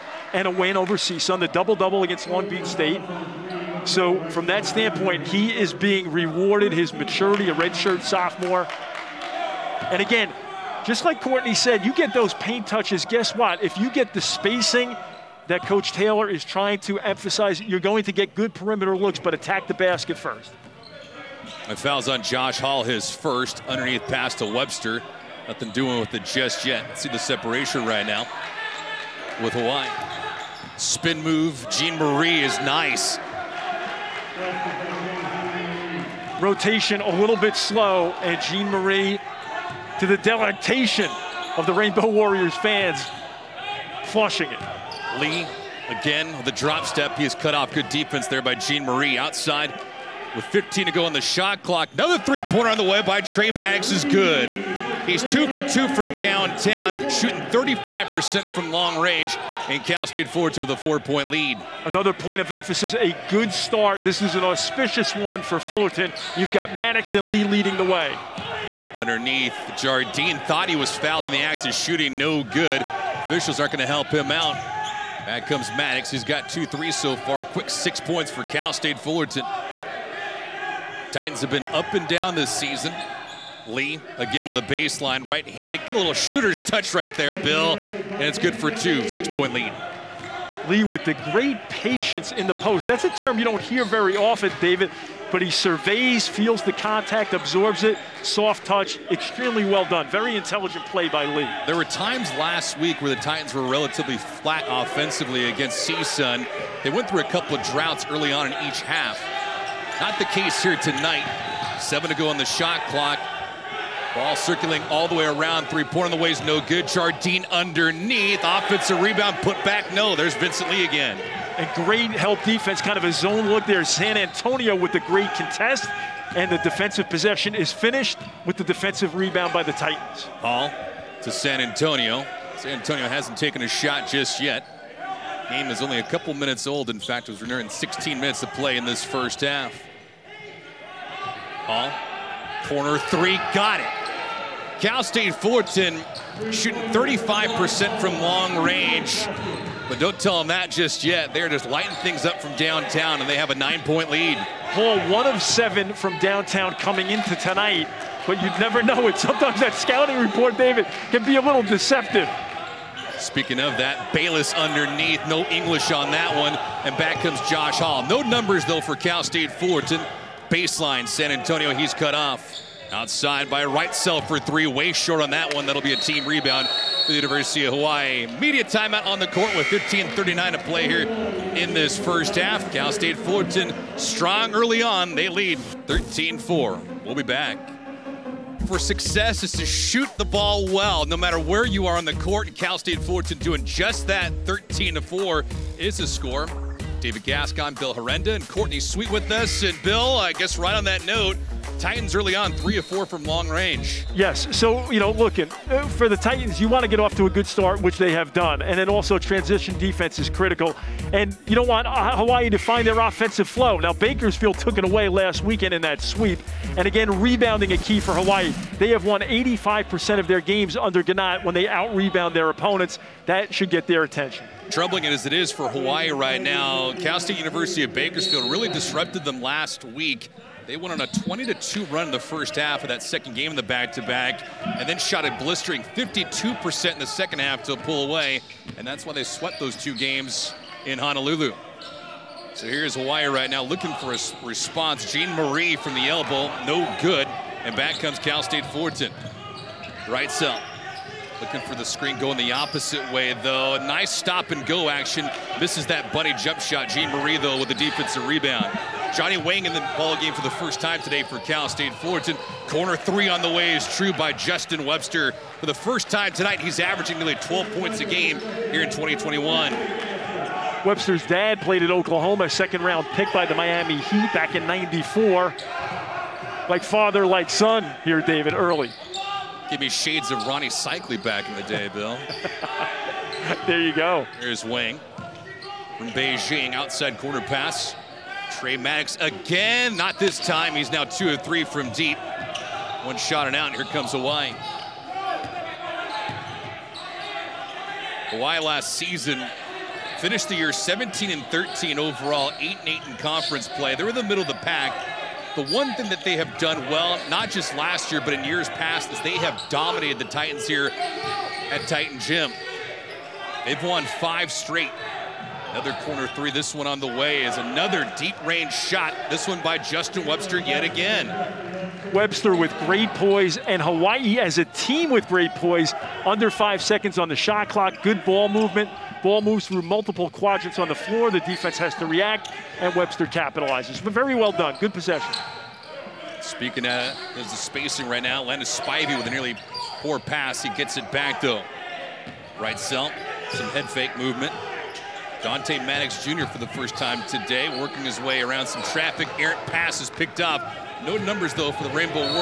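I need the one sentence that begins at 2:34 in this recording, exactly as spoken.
Hall one of seven from downtown coming into tonight, but you'd never know it.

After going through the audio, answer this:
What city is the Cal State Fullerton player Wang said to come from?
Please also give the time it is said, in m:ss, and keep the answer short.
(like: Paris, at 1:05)
Beijing, at 4:46.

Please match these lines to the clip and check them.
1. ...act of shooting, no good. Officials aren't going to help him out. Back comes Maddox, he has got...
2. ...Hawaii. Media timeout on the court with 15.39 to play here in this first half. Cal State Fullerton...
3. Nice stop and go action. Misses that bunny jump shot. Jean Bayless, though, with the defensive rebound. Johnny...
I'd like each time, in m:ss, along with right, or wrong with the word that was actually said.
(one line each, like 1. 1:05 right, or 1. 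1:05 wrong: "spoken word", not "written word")
1. 1:11 right
2. 2:57 right
3. 4:13 wrong: "Marie", not "Bayless".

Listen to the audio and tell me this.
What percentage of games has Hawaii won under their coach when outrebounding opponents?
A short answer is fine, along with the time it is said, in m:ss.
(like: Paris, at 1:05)
85%, at 3:39.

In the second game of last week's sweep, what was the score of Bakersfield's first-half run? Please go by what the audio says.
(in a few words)
20-2.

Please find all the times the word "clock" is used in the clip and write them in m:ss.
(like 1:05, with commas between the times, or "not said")
0:51, 1:52, 5:27.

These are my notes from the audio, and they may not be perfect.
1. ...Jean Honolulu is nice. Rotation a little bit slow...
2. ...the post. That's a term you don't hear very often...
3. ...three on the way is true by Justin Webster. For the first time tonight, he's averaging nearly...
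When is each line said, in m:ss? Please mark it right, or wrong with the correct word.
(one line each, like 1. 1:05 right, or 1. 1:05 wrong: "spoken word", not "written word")
1. 0:31 wrong: "Marie", not "Honolulu"
2. 1:32 right
3. 4:22 right.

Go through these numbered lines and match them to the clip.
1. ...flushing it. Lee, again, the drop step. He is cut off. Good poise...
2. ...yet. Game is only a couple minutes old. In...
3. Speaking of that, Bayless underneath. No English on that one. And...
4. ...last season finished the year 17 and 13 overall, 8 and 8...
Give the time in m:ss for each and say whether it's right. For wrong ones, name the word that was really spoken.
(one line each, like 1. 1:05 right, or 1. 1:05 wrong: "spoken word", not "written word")
1. 0:44 wrong: "defense", not "poise"
2. 2:14 right
3. 2:43 right
4. 4:58 right.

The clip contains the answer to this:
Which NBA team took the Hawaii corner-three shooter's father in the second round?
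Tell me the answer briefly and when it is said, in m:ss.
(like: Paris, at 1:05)
Miami Heat, at 4:33.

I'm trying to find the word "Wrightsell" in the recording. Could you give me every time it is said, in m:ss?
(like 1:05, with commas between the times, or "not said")
2:53, 5:42.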